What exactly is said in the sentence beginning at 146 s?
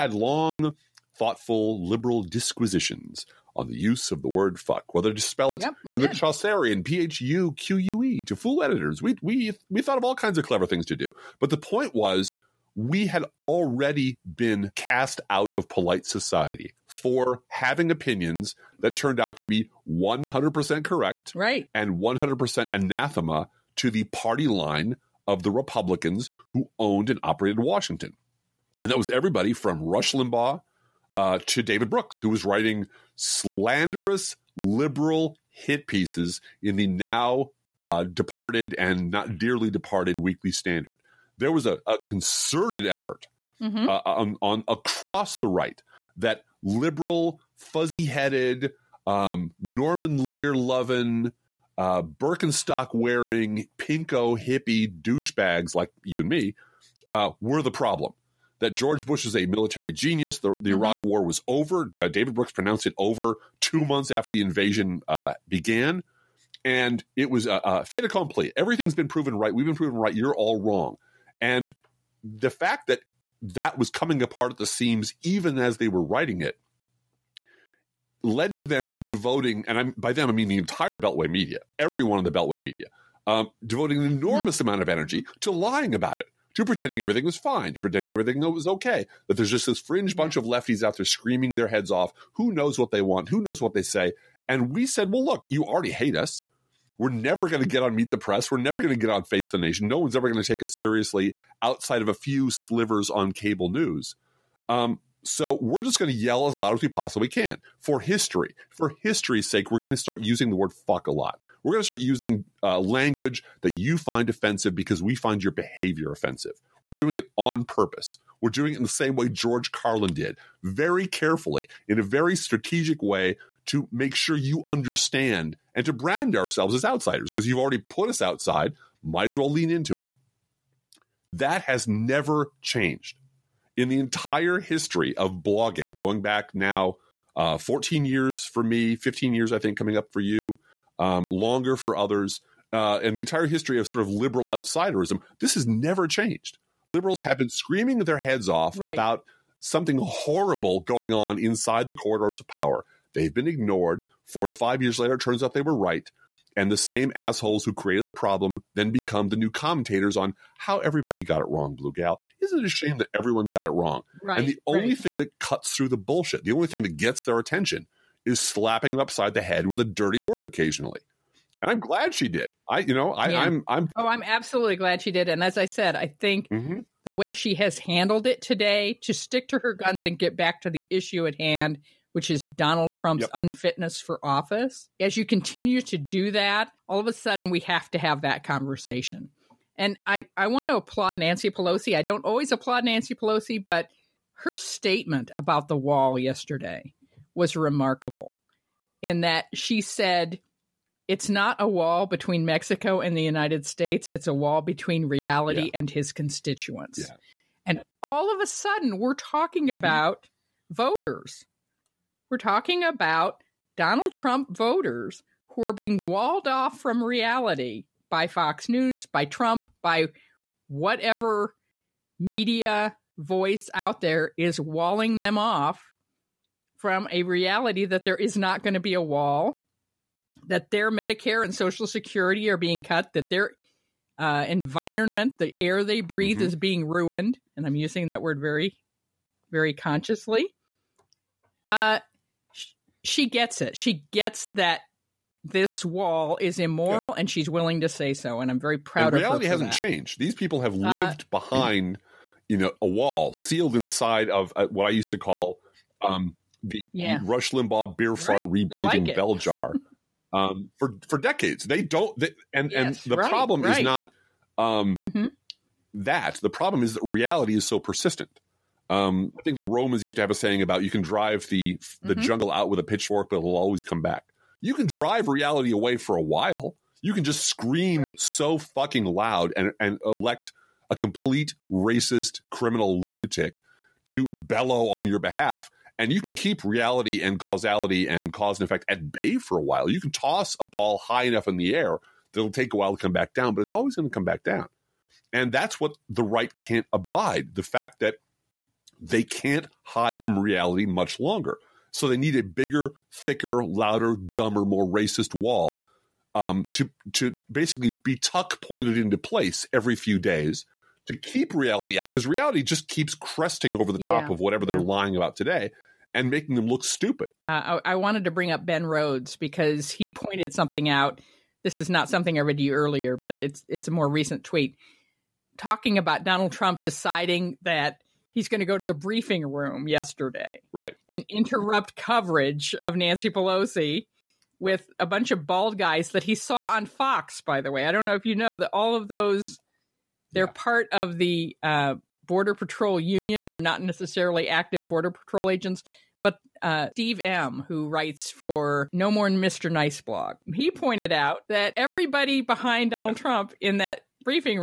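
Liberals have been screaming their heads off right.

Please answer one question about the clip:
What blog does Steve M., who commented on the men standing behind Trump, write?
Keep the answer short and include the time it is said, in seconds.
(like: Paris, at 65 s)
No More Mr. Nice blog, at 348 s.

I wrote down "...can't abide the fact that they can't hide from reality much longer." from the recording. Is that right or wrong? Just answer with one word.
right.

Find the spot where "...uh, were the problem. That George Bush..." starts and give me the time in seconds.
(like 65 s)
57 s.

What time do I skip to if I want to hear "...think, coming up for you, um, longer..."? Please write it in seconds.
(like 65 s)
139 s.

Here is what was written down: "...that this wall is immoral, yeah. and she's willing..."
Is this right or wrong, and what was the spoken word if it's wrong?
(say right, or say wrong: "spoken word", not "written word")
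right.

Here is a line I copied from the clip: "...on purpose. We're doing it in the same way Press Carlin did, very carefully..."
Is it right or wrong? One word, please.
wrong.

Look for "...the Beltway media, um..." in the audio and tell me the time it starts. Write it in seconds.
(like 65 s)
82 s.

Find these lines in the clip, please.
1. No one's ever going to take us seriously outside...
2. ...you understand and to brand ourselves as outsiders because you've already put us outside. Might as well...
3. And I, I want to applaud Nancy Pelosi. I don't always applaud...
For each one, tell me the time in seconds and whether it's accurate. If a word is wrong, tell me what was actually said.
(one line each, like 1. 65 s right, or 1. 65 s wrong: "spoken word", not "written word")
1. 99 s right
2. 124 s right
3. 189 s right.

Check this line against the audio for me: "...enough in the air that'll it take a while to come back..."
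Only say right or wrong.
right.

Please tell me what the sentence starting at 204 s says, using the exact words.
It's a wall between reality yeah.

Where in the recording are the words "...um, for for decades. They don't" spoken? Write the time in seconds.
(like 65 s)
260 s.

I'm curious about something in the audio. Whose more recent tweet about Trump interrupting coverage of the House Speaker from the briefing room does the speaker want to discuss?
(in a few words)
Ben Rhodes.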